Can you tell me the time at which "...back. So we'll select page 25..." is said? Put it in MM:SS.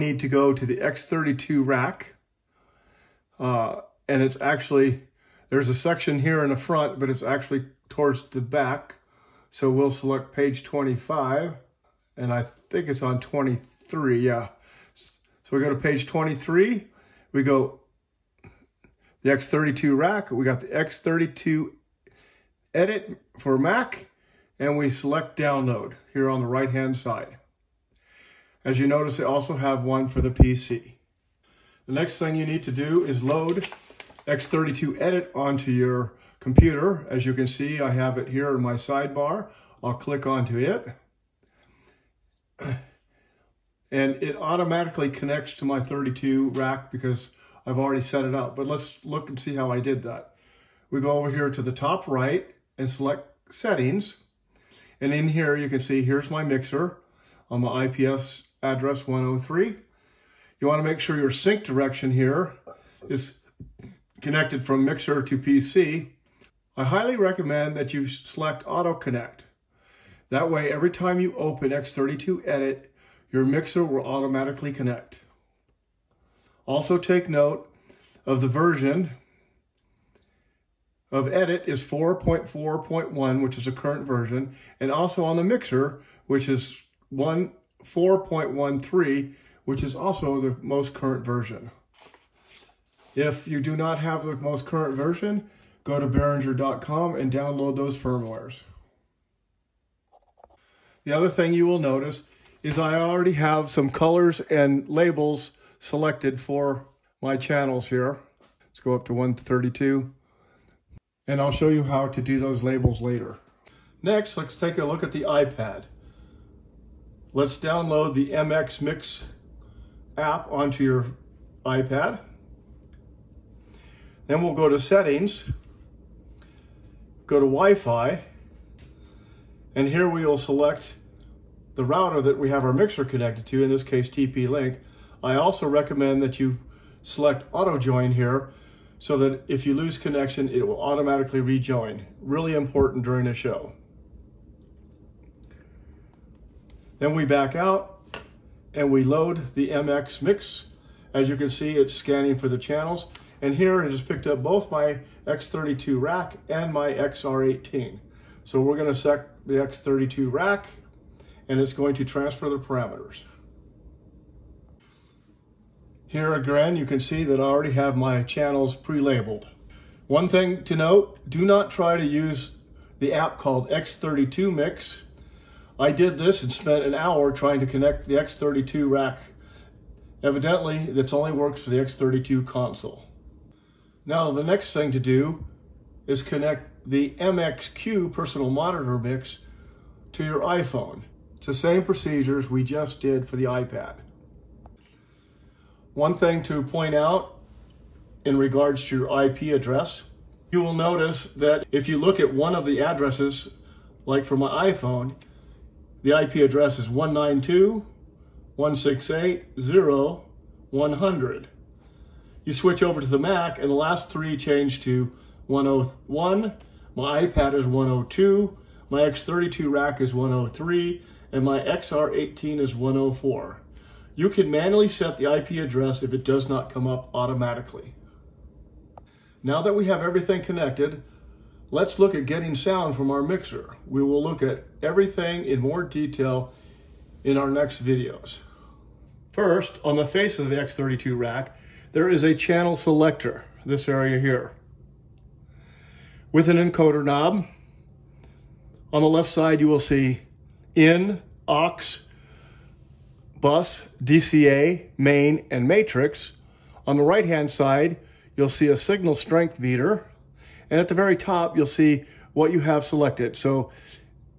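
00:08.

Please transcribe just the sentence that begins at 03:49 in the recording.
Now that we have everything connected, let's look at getting sound from our mixer.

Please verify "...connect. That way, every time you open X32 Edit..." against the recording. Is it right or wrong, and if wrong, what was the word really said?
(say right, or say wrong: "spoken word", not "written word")
right.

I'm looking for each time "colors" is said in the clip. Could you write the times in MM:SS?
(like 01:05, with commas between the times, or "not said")
01:43.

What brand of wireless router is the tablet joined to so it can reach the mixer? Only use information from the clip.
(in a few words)
TP-Link.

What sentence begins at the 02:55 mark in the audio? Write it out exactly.
I did this and spent an hour trying to connect the X32 rack.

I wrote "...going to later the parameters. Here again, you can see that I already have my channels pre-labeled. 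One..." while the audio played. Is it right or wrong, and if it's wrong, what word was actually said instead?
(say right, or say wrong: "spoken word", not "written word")
wrong: "transfer", not "later".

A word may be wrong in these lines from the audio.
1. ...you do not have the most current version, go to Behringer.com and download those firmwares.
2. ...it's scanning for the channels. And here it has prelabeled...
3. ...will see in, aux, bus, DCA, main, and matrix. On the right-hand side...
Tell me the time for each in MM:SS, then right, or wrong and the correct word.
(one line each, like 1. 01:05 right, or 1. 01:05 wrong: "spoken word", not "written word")
1. 01:33 right
2. 02:31 wrong: "picked", not "prelabeled"
3. 04:09 right.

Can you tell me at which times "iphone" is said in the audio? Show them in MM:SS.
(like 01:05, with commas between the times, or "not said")
03:10, 03:24.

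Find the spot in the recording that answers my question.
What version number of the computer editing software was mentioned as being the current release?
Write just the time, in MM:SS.
01:21.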